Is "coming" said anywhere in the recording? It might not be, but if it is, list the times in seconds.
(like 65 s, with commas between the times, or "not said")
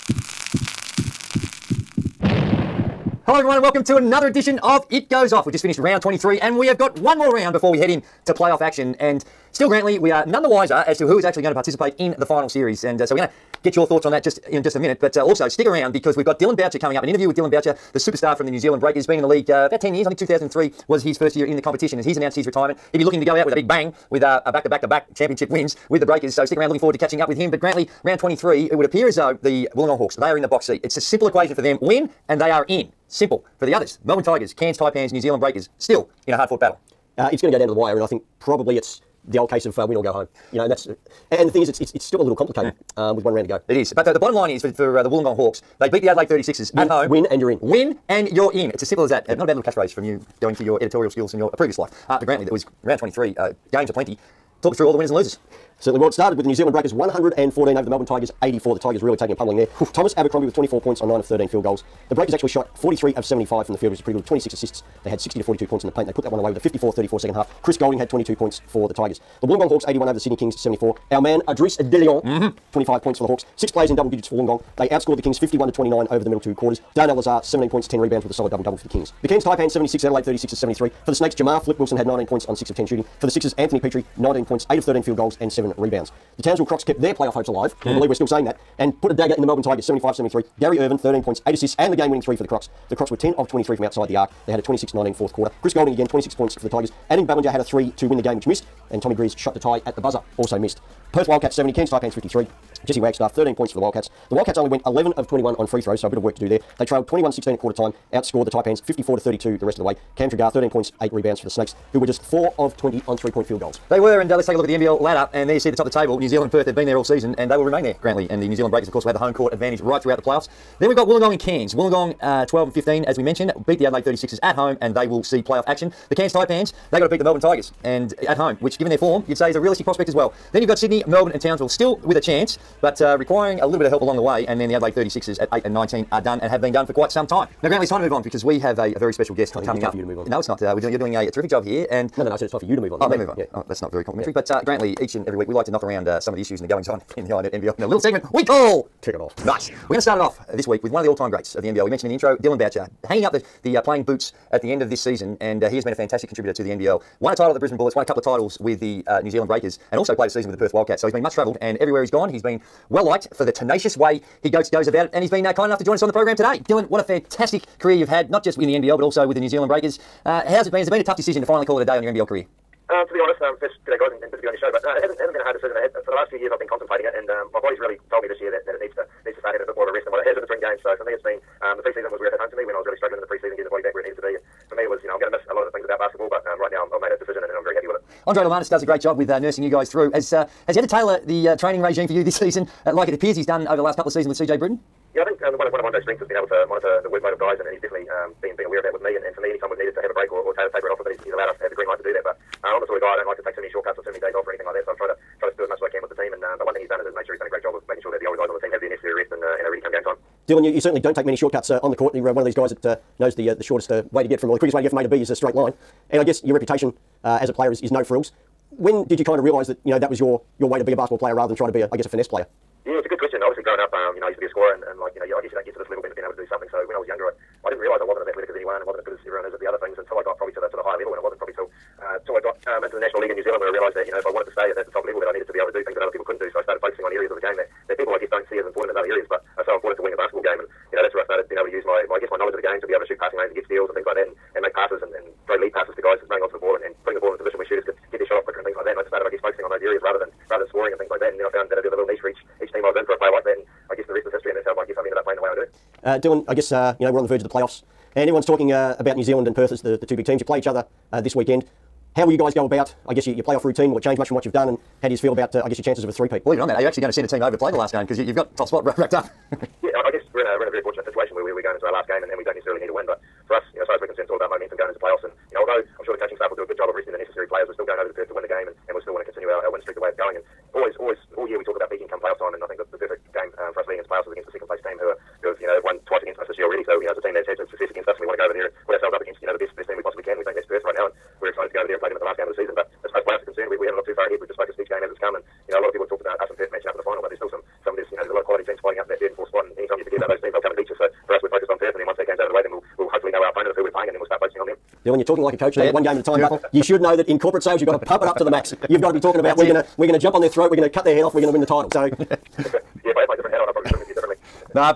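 16 s, 139 s.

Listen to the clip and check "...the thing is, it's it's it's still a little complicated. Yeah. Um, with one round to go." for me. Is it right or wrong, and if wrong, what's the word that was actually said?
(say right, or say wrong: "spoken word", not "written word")
right.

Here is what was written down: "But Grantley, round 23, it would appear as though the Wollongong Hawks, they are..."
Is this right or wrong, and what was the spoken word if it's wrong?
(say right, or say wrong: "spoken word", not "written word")
right.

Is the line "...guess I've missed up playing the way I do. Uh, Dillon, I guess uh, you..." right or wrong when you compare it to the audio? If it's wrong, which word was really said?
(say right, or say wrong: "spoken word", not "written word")
wrong: "ended", not "missed".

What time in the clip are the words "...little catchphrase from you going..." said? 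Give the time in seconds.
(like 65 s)
49 s.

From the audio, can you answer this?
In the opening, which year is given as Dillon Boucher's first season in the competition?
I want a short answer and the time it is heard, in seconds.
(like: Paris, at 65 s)
2003, at 20 s.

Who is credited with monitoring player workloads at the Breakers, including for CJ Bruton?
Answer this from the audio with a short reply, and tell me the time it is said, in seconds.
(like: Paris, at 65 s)
Andre Lomanis, at 188 s.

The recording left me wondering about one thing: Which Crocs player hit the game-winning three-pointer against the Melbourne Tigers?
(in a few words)
Gary Ervin.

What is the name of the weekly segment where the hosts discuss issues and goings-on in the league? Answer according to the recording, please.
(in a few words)
Tick It Off.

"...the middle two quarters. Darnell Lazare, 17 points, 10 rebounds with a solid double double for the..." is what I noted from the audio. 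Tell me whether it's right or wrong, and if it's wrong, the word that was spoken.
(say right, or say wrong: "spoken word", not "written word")
right.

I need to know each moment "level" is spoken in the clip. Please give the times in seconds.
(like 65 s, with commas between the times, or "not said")
225 s, 230 s, 235 s.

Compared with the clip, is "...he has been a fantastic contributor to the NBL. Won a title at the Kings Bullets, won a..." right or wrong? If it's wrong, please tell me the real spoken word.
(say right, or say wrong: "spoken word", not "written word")
wrong: "Brisbane", not "Kings".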